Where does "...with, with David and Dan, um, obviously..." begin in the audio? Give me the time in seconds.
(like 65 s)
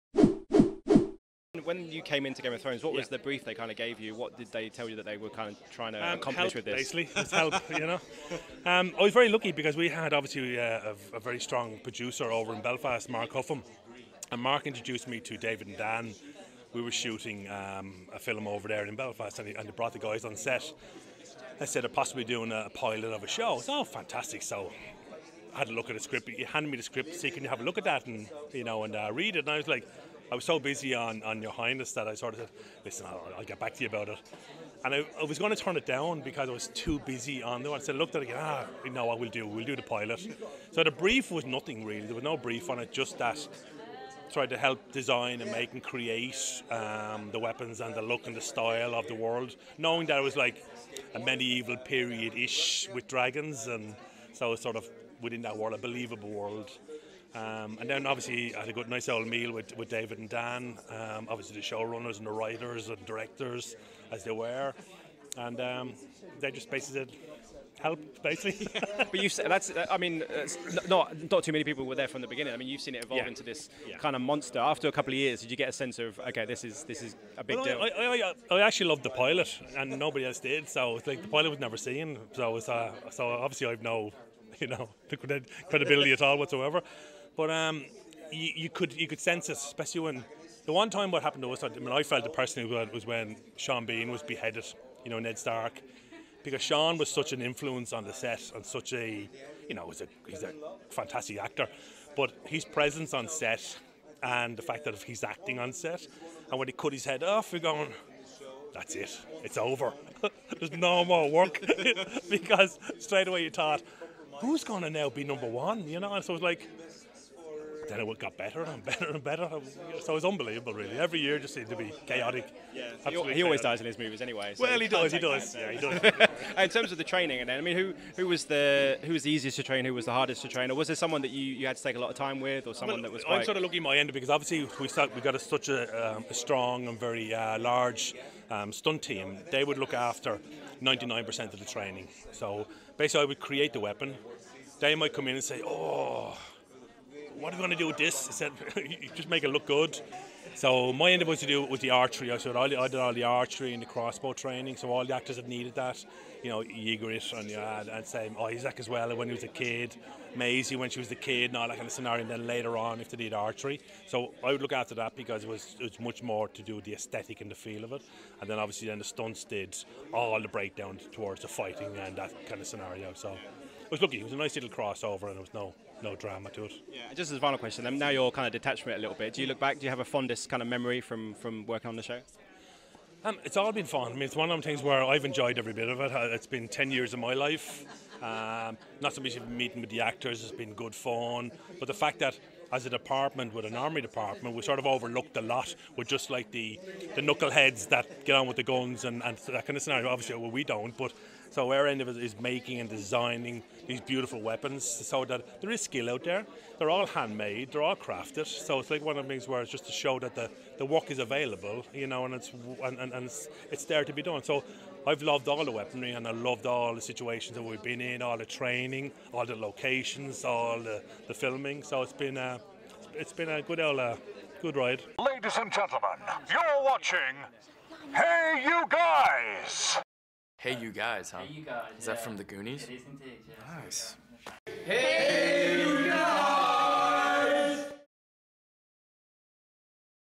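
59 s.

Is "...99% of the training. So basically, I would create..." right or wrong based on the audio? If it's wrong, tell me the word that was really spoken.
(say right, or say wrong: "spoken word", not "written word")
right.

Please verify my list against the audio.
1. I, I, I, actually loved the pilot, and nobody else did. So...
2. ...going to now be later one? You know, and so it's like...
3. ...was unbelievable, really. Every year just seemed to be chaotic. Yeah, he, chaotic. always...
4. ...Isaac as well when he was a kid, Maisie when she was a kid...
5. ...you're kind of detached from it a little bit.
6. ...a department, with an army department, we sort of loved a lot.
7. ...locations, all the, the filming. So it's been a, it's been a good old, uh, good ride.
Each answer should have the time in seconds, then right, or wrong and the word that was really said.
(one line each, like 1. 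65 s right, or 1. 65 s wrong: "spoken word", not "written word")
1. 77 s right
2. 114 s wrong: "number", not "later"
3. 120 s right
4. 158 s right
5. 178 s right
6. 192 s wrong: "overlooked", not "loved"
7. 219 s right.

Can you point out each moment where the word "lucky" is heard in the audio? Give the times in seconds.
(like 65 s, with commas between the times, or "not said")
9 s, 133 s, 174 s.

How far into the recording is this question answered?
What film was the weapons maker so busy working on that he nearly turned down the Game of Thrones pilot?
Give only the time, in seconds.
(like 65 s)
31 s.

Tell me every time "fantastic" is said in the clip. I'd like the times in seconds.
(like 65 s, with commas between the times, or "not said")
23 s, 100 s.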